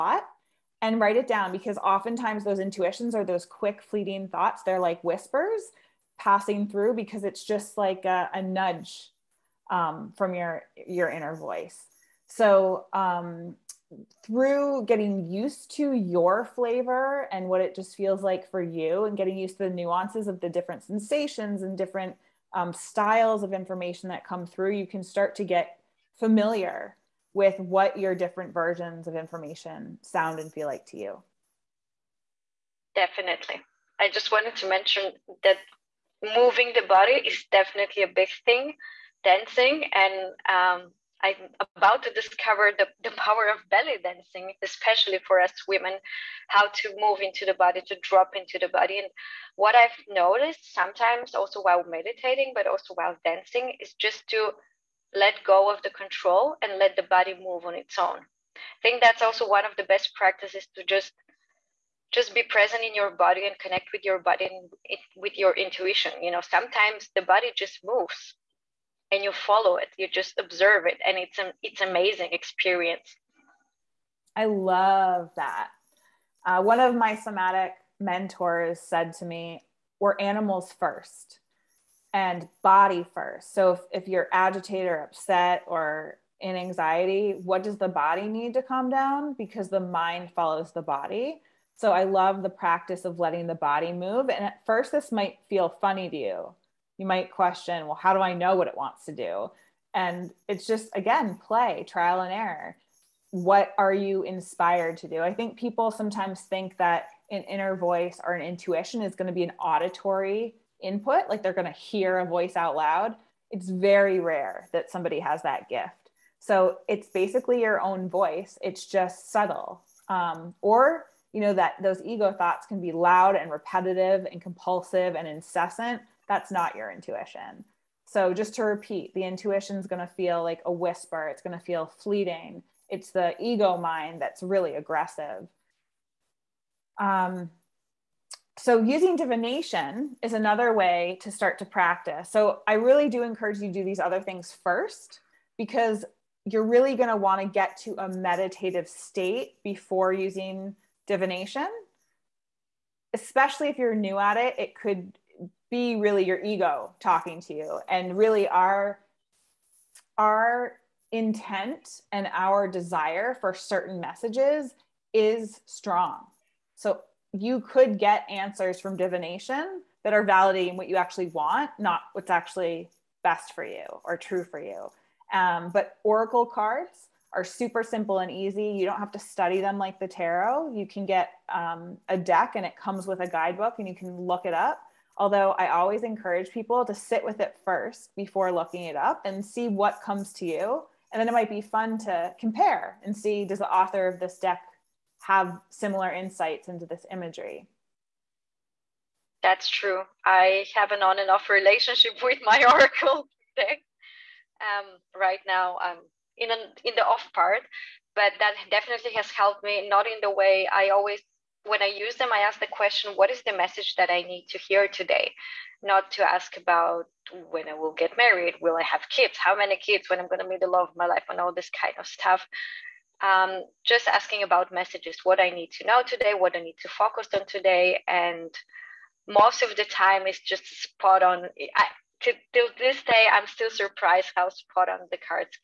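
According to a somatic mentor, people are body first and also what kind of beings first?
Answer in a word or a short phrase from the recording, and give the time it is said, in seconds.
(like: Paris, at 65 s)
Animals, at 80 s.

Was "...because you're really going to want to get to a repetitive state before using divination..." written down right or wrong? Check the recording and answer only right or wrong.
wrong.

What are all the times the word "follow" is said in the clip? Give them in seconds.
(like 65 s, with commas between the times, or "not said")
69 s, 90 s.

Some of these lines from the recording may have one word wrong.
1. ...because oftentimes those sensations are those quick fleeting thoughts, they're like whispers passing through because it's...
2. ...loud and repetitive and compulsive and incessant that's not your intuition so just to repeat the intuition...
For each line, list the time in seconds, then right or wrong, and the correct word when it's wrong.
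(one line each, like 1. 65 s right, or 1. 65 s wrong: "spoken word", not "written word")
1. 1 s wrong: "intuitions", not "sensations"
2. 122 s right.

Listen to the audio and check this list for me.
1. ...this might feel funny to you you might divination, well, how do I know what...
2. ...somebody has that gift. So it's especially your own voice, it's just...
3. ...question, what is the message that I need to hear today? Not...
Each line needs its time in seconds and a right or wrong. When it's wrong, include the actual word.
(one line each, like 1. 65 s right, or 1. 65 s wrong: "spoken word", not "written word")
1. 94 s wrong: "question", not "divination"
2. 114 s wrong: "basically", not "especially"
3. 212 s right.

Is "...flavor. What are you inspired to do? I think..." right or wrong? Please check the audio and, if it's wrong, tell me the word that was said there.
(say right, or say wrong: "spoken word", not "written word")
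wrong: "error", not "flavor".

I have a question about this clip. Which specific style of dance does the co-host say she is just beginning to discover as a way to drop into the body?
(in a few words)
Belly dancing.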